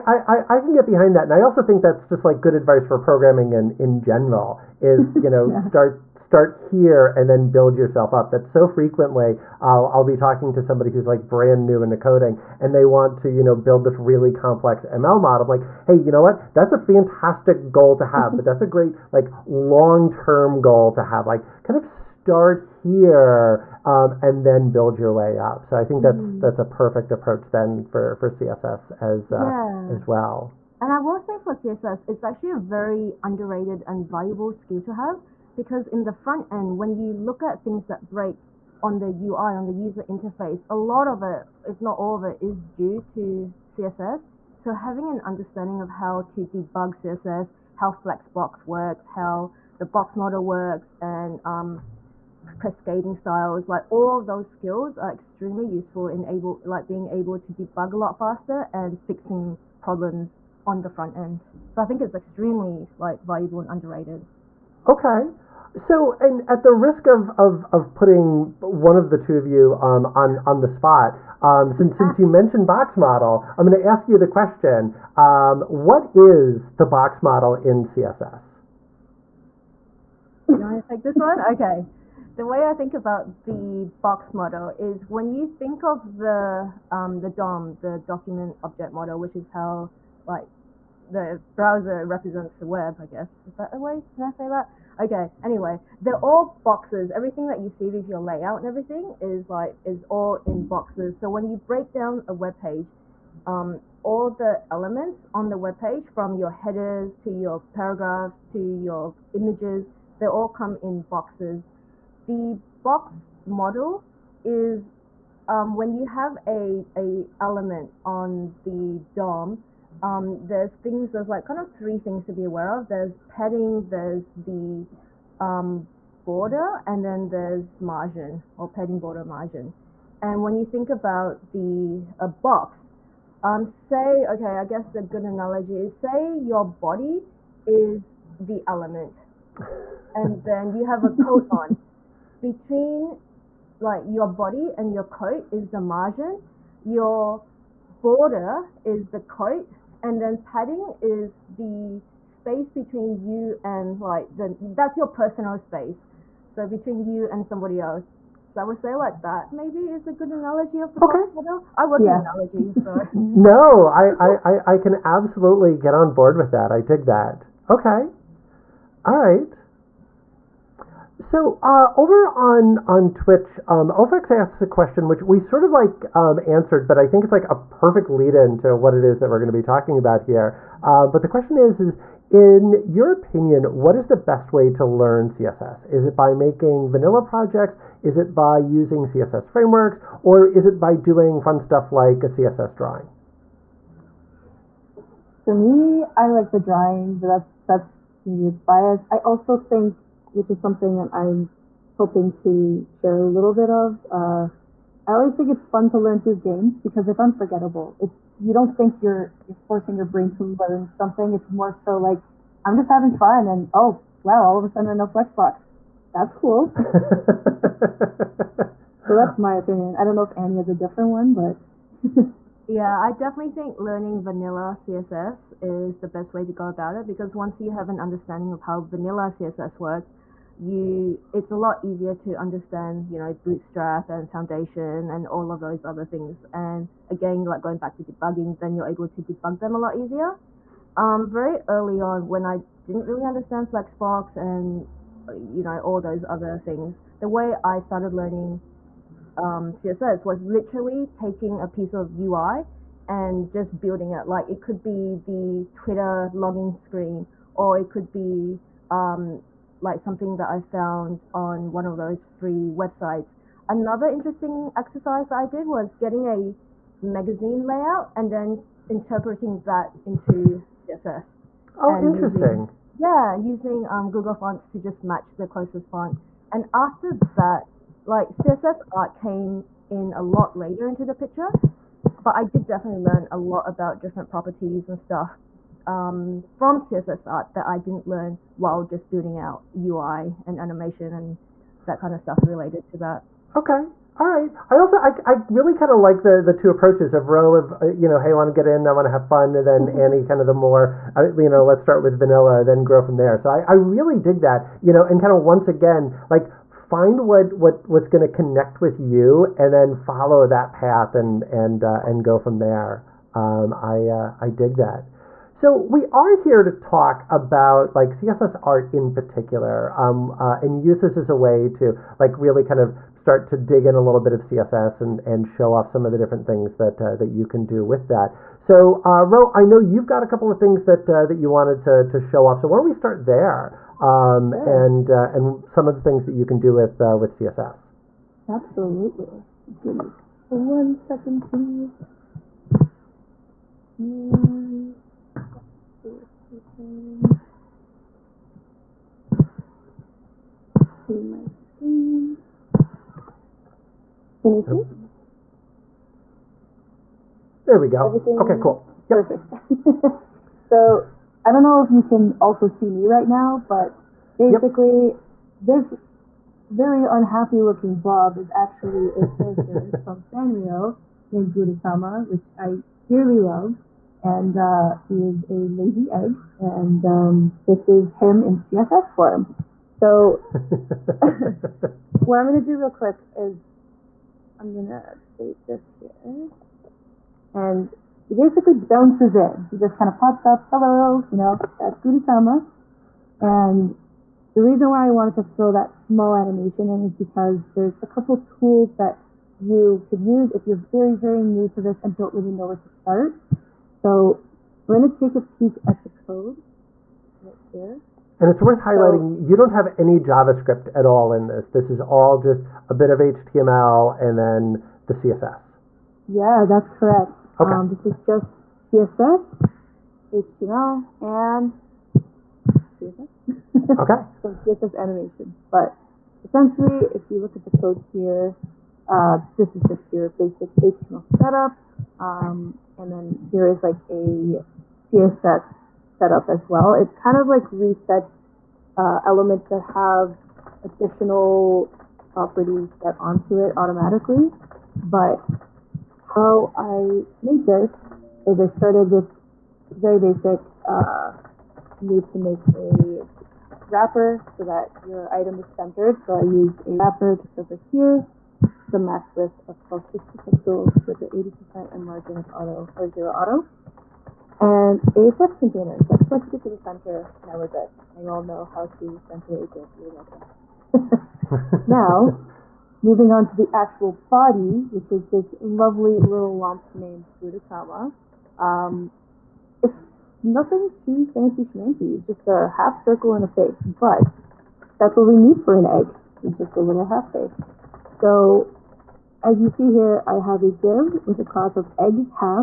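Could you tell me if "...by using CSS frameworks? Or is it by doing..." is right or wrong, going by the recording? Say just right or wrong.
right.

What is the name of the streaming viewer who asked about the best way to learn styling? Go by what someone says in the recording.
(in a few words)
Ofex.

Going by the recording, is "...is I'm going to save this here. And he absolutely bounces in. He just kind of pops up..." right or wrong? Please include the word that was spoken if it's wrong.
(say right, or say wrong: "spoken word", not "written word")
wrong: "basically", not "absolutely".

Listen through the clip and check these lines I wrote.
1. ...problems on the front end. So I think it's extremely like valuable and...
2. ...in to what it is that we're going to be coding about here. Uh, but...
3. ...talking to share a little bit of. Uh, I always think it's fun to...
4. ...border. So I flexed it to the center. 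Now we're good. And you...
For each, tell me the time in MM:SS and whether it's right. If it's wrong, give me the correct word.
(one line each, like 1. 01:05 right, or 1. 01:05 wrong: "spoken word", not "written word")
1. 00:59 right
2. 02:58 wrong: "talking", not "coding"
3. 03:21 wrong: "hoping", not "talking"
4. 07:45 wrong: "container", not "border".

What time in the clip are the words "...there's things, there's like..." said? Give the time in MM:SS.
02:00.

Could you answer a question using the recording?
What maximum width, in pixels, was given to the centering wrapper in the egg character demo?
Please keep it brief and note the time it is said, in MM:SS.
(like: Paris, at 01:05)
1260, at 07:39.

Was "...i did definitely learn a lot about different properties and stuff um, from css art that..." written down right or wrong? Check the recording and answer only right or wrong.
right.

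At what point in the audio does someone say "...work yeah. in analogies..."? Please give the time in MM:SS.
02:41.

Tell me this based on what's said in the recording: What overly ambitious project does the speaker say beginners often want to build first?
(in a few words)
ML model.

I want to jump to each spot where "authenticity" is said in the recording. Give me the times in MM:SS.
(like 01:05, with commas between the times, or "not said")
not said.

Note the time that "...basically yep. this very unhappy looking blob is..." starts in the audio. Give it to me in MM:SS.
06:04.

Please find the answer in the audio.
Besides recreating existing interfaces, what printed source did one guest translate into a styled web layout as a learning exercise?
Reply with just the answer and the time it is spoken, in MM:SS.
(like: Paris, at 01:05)
a magazine layout, at 04:27.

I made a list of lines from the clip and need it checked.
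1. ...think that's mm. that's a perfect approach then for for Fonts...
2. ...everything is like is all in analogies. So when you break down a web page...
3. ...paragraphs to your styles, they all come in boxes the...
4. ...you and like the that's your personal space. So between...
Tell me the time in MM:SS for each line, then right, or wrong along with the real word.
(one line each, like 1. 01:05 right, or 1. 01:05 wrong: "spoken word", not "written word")
1. 00:25 wrong: "CSS", not "Fonts"
2. 01:38 wrong: "boxes", not "analogies"
3. 01:47 wrong: "images", not "styles"
4. 02:33 right.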